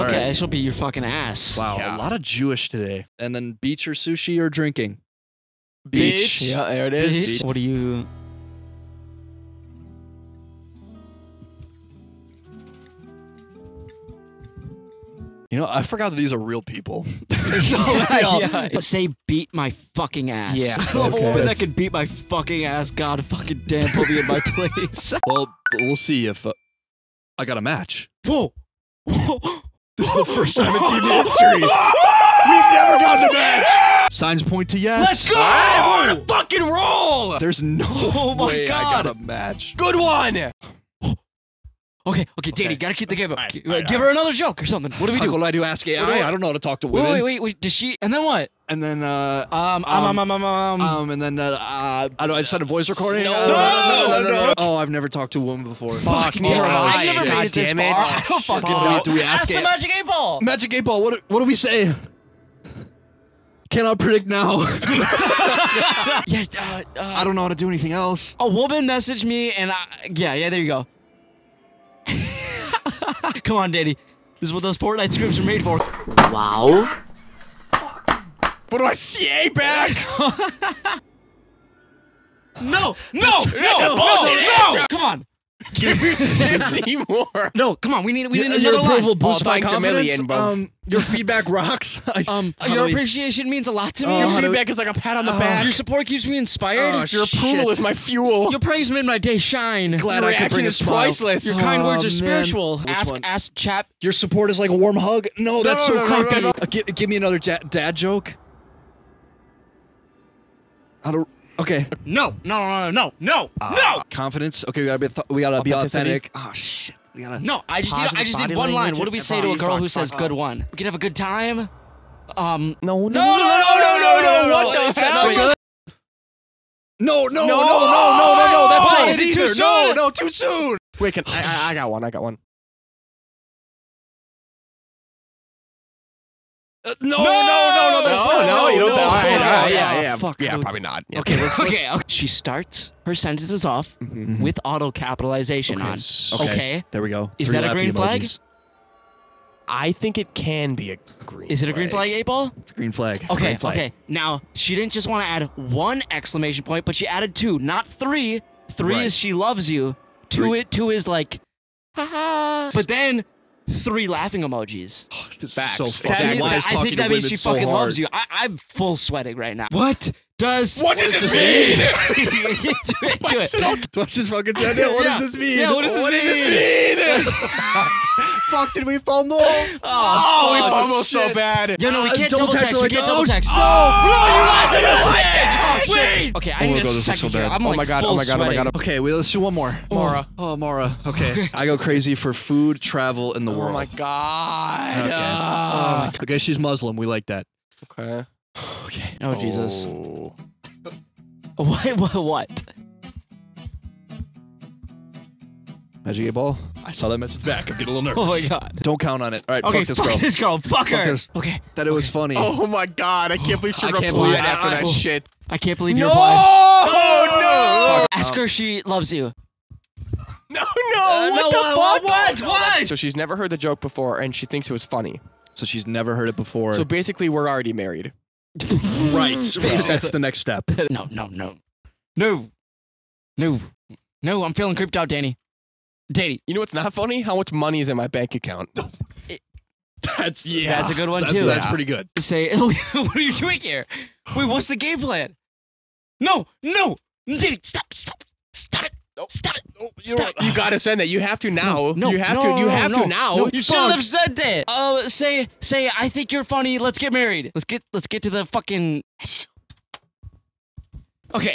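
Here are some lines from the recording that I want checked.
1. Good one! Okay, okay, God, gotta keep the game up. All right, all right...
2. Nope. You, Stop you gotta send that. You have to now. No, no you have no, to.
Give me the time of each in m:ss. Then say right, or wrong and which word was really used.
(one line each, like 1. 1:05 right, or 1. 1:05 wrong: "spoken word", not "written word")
1. 0:39 wrong: "Danny", not "God"
2. 4:09 right.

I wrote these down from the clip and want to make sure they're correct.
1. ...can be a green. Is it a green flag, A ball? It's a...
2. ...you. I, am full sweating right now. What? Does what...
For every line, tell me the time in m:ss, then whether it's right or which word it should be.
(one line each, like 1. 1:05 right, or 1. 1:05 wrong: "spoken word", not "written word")
1. 2:30 right
2. 2:47 right.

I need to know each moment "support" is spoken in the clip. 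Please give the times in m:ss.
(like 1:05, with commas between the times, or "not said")
1:35, 1:44.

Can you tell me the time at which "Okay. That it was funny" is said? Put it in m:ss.
3:31.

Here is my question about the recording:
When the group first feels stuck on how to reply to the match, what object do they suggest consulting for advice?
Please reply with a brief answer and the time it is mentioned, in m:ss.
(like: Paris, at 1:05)
Magic eight ball, at 0:59.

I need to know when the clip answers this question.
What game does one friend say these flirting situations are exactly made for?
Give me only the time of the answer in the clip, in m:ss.
1:14.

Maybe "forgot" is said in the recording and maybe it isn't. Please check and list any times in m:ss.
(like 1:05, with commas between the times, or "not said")
0:15.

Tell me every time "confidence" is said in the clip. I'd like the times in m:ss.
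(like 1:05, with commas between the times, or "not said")
1:29, 1:54.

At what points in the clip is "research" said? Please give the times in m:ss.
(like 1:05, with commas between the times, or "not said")
not said.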